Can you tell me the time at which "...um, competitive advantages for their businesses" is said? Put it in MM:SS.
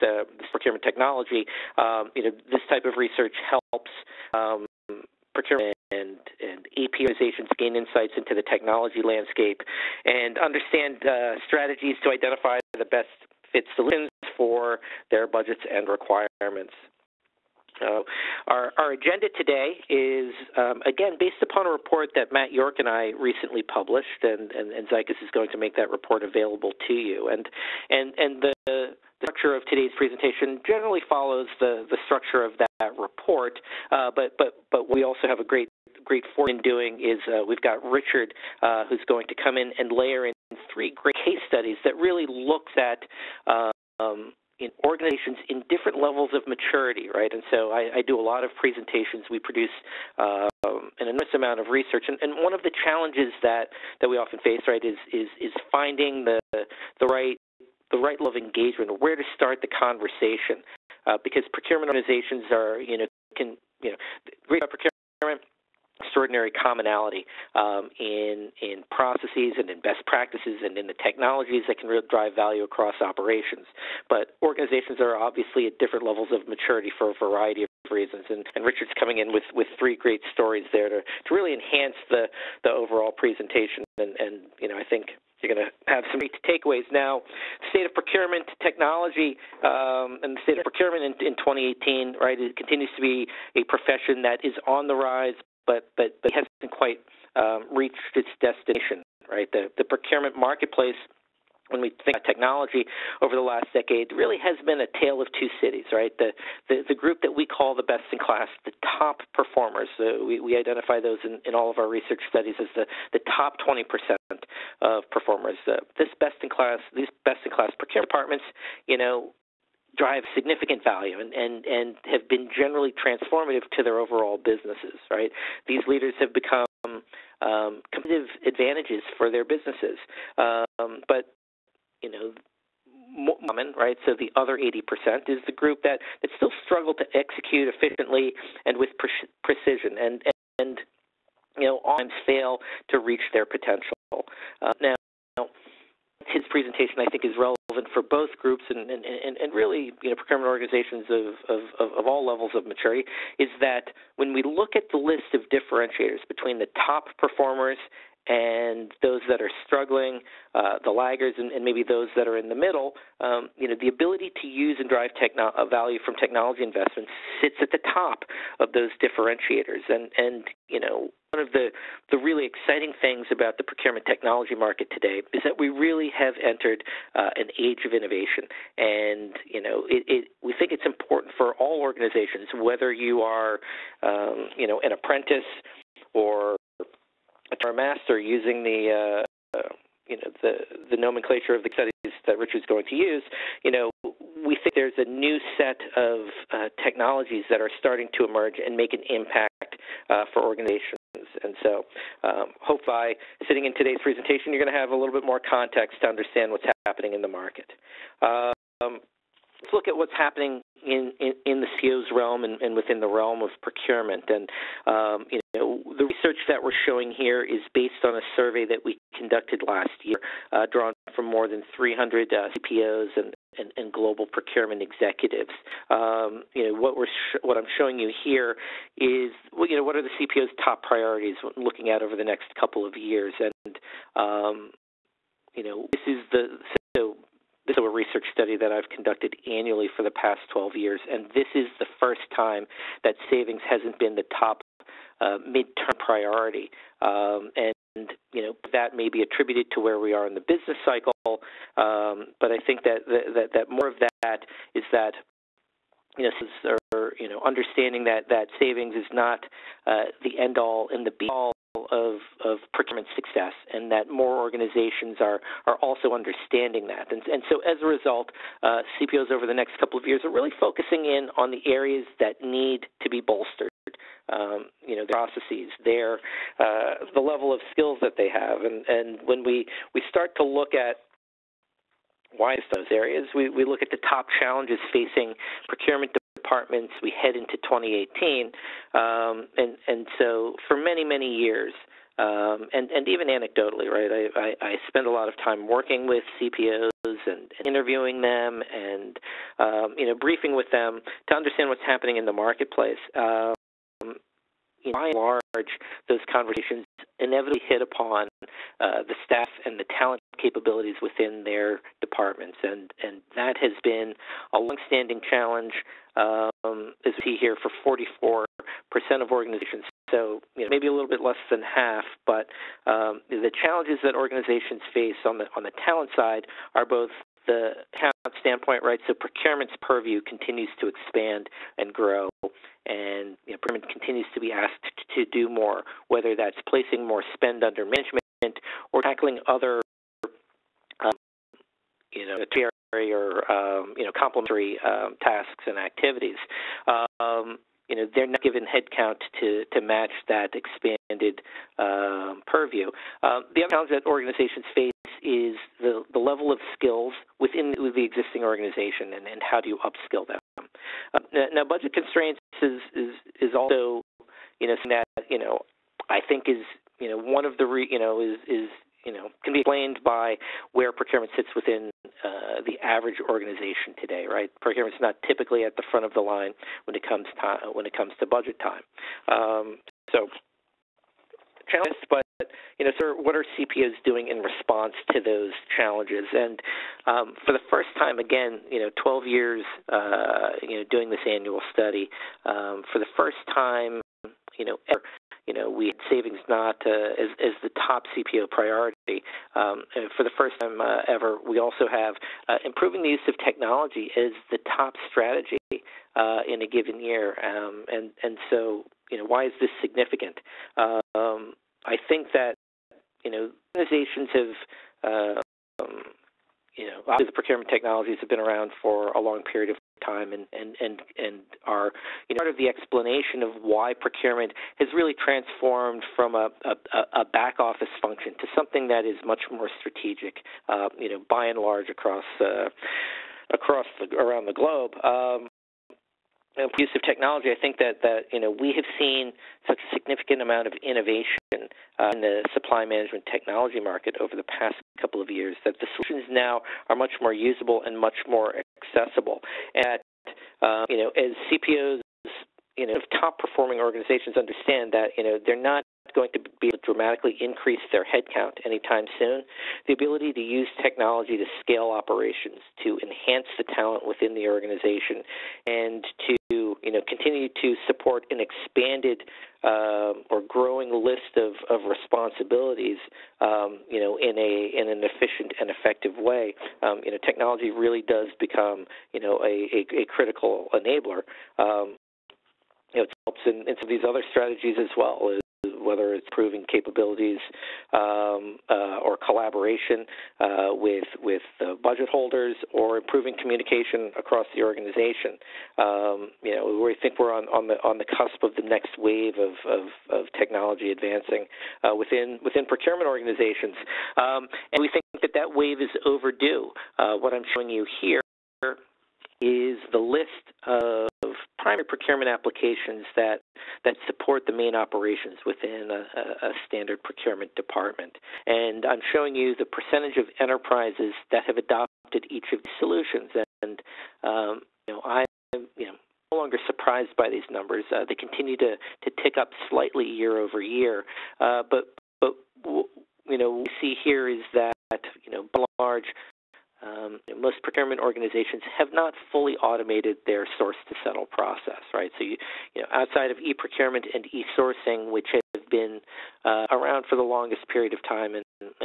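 02:07.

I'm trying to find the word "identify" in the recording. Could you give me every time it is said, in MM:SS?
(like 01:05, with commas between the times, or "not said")
00:12, 01:50.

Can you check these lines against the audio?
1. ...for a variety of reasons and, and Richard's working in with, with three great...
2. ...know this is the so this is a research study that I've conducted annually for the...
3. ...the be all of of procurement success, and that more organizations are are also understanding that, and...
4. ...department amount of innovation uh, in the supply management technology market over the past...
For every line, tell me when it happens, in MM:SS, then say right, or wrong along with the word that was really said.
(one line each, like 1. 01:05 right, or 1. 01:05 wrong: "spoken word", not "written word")
1. 01:16 wrong: "coming", not "working"
2. 03:55 right
3. 04:21 right
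4. 07:19 wrong: "significant", not "department".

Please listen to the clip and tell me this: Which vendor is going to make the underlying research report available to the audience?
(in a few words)
Zycus.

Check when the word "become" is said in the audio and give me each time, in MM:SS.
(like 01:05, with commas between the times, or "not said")
02:06, 07:58.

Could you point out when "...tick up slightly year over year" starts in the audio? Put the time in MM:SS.
08:49.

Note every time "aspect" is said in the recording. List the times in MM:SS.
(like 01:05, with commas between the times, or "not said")
not said.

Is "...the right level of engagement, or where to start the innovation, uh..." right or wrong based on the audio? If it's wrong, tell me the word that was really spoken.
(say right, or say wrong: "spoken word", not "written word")
wrong: "conversation", not "innovation".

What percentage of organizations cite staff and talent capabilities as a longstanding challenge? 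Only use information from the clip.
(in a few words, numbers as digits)
44 percent.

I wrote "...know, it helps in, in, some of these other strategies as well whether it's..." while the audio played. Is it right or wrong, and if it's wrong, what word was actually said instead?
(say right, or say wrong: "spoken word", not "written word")
right.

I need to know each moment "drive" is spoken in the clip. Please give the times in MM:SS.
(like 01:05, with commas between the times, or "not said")
01:12, 01:59, 02:44.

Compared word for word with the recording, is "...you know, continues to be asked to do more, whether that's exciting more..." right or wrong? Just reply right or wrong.
wrong.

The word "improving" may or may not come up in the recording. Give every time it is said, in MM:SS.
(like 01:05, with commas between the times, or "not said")
06:42, 08:12.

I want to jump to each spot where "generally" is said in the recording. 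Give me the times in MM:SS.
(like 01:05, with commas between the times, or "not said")
00:30, 02:02.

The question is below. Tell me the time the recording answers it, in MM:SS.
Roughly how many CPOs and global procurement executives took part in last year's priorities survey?
03:41.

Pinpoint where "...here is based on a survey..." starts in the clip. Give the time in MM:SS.
03:37.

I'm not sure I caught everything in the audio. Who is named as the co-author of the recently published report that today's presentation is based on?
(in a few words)
Matt York.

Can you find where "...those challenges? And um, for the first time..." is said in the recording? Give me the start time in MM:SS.
06:25.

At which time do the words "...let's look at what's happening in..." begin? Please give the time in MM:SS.
03:29.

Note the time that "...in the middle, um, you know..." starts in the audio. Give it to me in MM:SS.
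02:42.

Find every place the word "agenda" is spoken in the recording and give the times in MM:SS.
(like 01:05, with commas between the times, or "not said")
00:18.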